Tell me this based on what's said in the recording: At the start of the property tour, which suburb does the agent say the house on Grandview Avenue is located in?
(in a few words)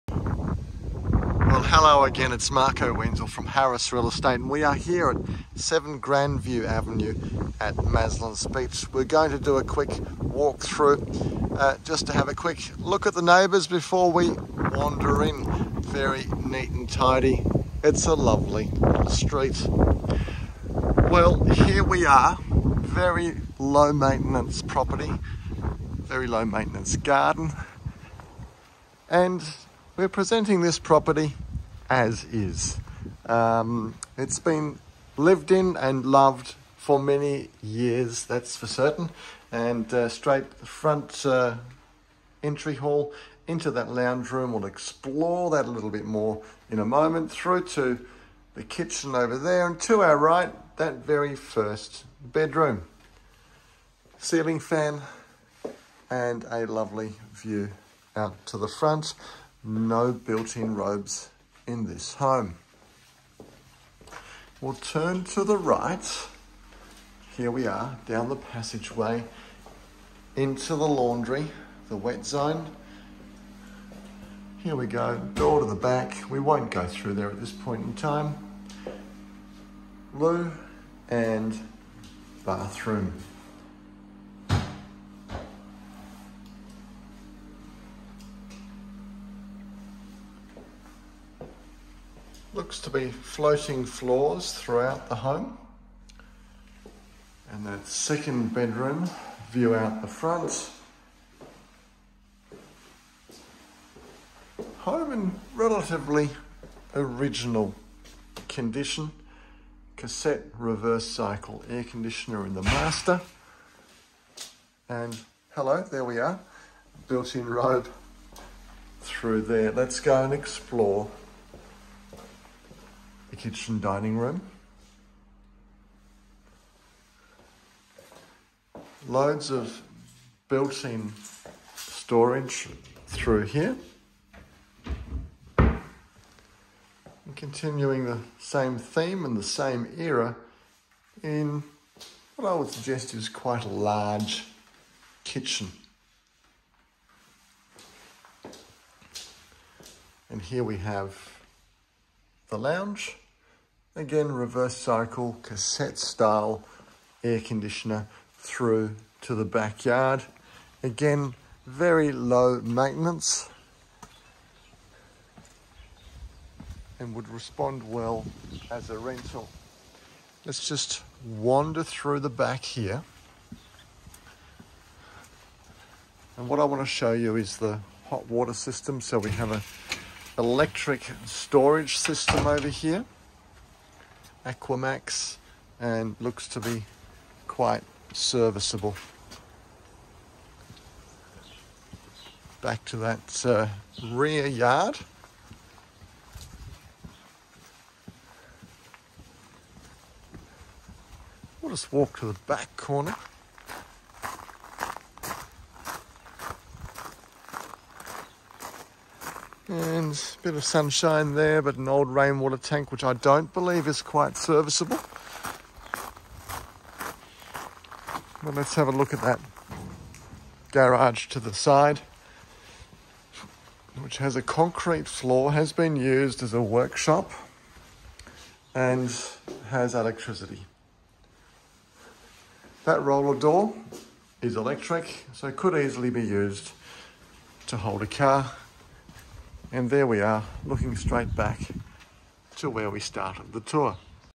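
Maslins Beach.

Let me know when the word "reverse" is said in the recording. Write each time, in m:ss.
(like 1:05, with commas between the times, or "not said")
1:50, 2:34.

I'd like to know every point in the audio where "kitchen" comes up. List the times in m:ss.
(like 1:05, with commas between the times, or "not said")
0:48, 2:03, 2:25.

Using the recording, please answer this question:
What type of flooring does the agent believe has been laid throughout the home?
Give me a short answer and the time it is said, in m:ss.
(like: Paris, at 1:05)
Floating floors, at 1:33.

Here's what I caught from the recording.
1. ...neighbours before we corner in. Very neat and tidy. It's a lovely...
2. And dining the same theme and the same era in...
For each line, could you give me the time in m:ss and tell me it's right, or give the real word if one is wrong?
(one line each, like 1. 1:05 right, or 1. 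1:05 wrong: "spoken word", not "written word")
1. 0:13 wrong: "wander", not "corner"
2. 2:15 wrong: "continuing", not "dining".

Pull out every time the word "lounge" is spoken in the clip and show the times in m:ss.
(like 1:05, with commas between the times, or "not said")
0:43, 2:32.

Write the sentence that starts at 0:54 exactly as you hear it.
Ceiling fan and a lovely view out to the front.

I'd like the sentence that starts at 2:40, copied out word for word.
Again, very low maintenance and would respond well as a rental.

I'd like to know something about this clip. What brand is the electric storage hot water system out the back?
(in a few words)
Aquamax.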